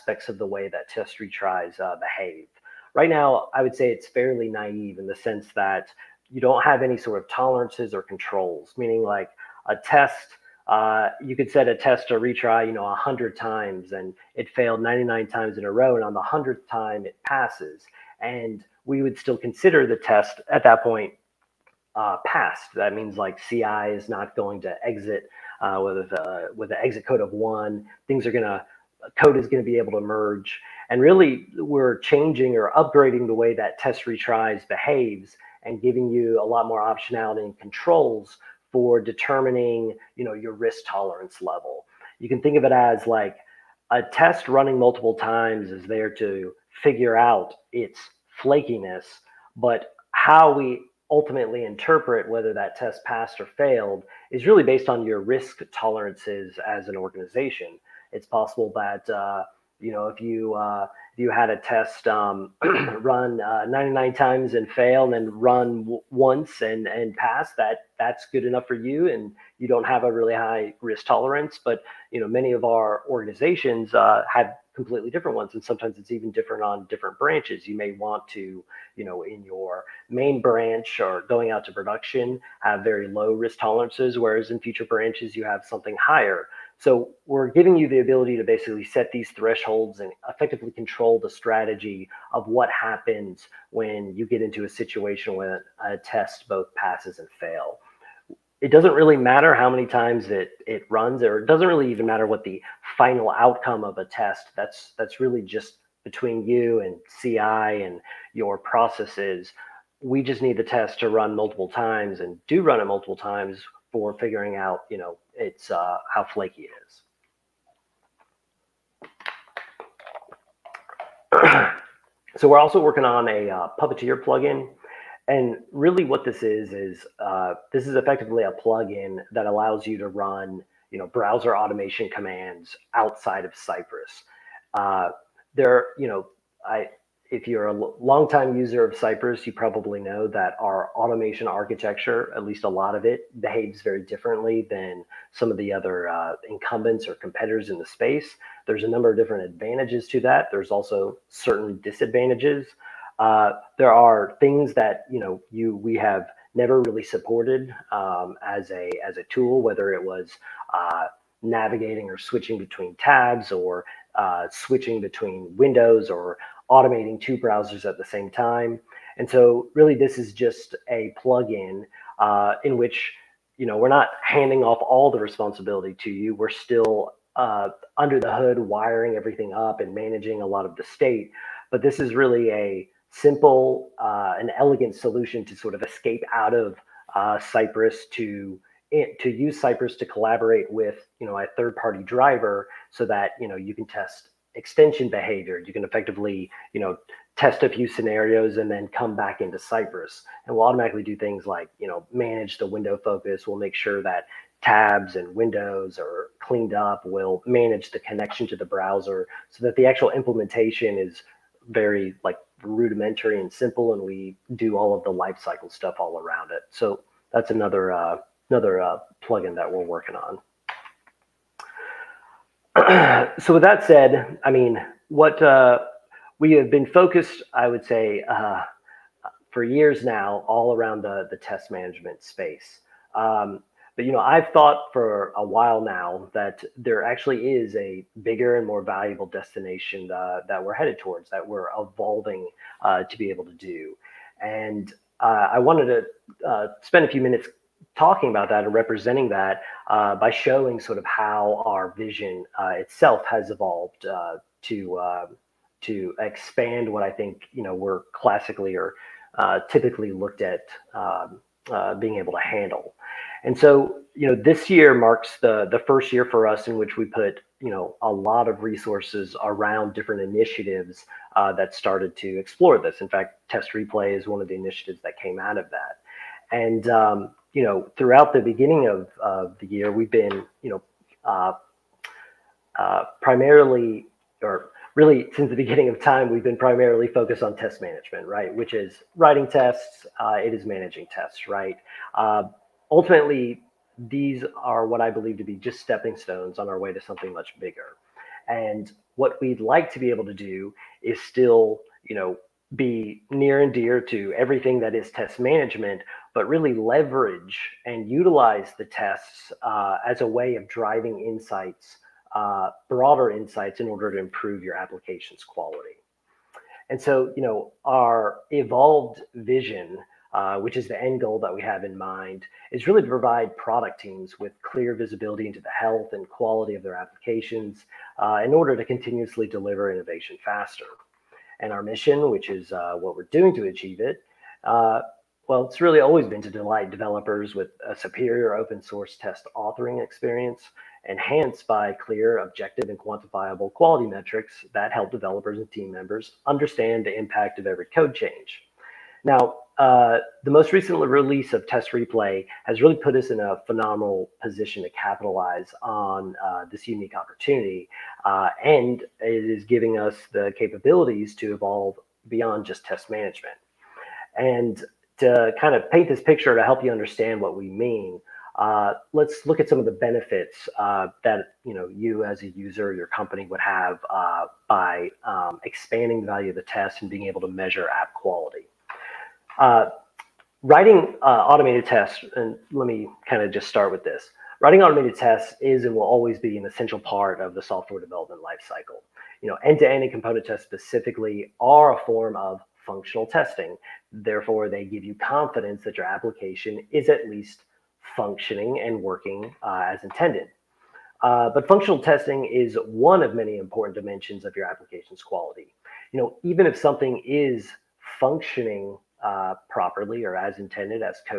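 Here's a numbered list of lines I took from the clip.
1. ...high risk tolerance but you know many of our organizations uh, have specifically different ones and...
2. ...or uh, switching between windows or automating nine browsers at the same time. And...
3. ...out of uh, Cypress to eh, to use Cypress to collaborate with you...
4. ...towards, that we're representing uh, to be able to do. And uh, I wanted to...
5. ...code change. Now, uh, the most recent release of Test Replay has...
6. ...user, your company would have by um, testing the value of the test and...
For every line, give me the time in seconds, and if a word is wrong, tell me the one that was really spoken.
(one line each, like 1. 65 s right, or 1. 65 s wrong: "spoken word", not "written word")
1. 70 s wrong: "completely", not "specifically"
2. 163 s wrong: "two", not "nine"
3. 186 s right
4. 240 s wrong: "evolving", not "representing"
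5. 347 s right
6. 372 s wrong: "expanding", not "testing".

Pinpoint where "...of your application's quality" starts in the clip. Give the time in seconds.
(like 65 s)
404 s.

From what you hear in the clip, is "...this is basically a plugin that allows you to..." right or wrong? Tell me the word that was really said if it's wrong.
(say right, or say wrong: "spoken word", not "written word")
wrong: "effectively", not "basically".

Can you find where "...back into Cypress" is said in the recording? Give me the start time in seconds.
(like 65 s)
199 s.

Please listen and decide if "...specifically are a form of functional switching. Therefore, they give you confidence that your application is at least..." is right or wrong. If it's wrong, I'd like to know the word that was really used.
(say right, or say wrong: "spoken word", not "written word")
wrong: "testing", not "switching".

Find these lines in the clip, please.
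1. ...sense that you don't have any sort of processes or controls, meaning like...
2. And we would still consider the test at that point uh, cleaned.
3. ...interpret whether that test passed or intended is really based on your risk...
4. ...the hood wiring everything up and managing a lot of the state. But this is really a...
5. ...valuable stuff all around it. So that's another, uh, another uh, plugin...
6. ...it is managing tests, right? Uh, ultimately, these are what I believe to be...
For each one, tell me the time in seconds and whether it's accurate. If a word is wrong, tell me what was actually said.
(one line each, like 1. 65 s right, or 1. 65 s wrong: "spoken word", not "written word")
1. 5 s wrong: "tolerances", not "processes"
2. 18 s wrong: "passed", not "cleaned"
3. 51 s wrong: "failed", not "intended"
4. 178 s right
5. 215 s wrong: "lifecycle", not "valuable"
6. 290 s right.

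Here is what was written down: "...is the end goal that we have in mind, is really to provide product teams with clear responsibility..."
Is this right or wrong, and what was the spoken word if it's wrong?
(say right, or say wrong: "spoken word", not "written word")
wrong: "visibility", not "responsibility".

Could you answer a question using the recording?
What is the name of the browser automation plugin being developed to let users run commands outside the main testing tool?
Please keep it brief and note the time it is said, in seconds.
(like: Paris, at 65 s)
Puppeteer, at 123 s.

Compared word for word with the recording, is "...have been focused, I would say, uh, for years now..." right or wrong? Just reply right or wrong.
right.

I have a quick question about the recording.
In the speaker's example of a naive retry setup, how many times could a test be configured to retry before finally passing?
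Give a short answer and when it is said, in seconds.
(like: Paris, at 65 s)
100, at 12 s.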